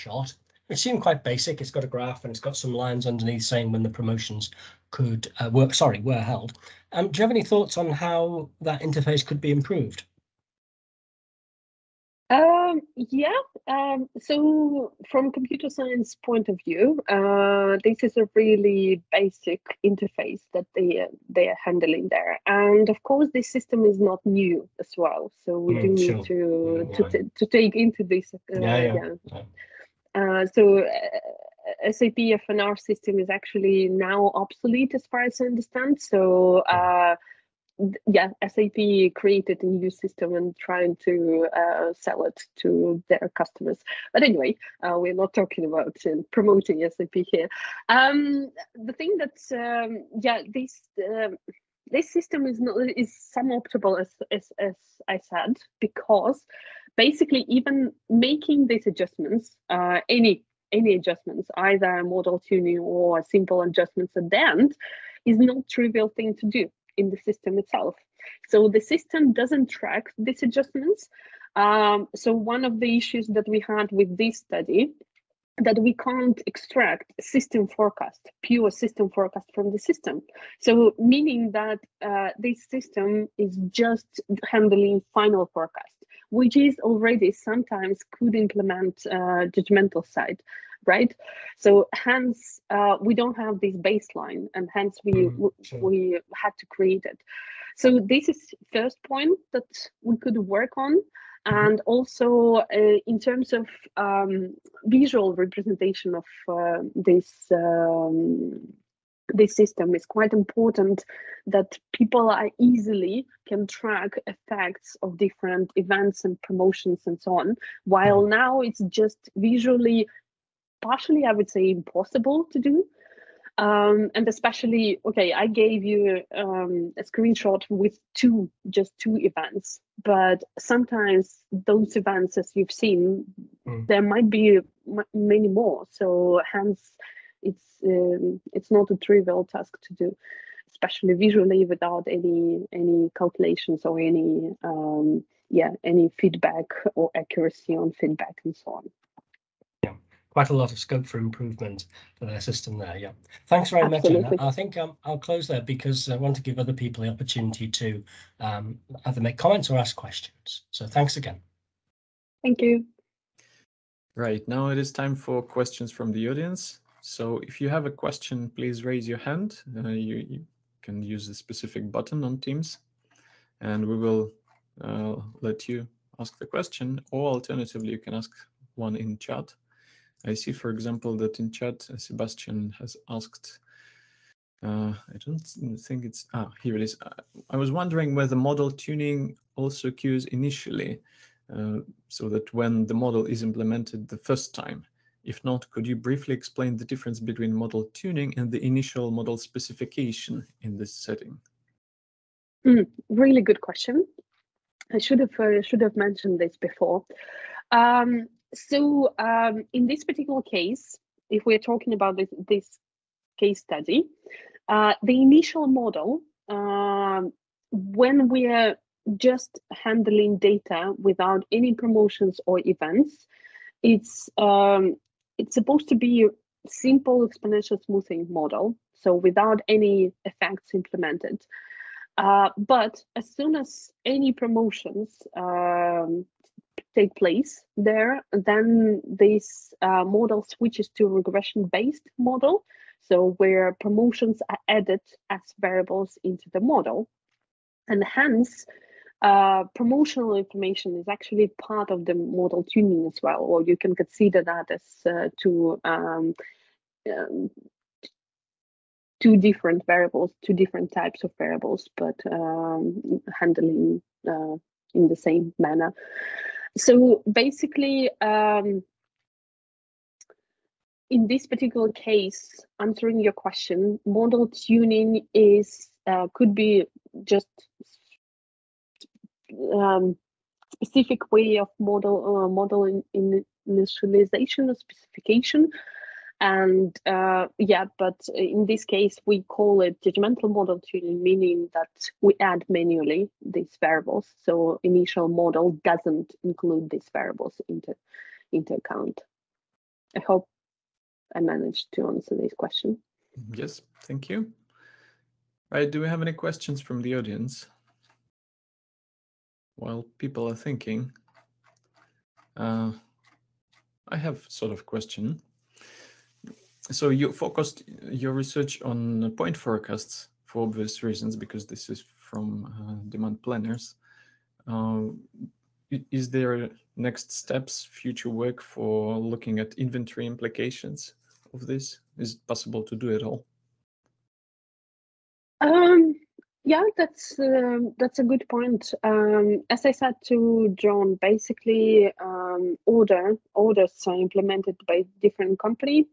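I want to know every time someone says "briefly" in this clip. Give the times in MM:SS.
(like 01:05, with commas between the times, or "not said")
03:15.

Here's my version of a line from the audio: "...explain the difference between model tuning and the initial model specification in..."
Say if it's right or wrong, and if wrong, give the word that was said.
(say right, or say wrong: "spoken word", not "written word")
right.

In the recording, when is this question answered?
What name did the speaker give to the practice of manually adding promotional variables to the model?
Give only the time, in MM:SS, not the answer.
04:50.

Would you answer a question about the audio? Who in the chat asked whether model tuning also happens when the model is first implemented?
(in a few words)
Sebastian.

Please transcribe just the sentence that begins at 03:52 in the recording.
Uh, but as soon as any promotions um, take place there.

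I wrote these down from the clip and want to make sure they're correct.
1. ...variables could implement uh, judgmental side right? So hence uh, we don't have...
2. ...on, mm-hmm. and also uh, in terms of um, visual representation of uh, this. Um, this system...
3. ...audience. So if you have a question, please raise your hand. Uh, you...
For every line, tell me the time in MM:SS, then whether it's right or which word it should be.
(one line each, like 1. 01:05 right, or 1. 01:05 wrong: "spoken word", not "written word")
1. 01:27 wrong: "sometimes", not "variables"
2. 01:40 right
3. 02:46 right.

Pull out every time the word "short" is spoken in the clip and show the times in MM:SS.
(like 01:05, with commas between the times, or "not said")
not said.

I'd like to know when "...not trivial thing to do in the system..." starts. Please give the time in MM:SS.
01:05.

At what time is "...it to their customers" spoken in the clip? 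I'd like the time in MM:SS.
00:42.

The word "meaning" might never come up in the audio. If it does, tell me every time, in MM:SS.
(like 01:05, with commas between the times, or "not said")
01:20, 04:51.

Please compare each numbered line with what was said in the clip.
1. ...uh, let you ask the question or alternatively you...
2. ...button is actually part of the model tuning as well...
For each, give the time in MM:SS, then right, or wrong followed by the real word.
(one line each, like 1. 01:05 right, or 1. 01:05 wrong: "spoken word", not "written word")
1. 02:54 right
2. 04:10 wrong: "information", not "button".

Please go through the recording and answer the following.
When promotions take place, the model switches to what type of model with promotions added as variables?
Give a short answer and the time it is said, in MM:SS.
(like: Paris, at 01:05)
regression-based model, at 04:01.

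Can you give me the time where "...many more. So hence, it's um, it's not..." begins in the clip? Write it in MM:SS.
02:15.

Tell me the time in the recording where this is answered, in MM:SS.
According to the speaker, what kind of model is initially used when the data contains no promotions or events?
03:46.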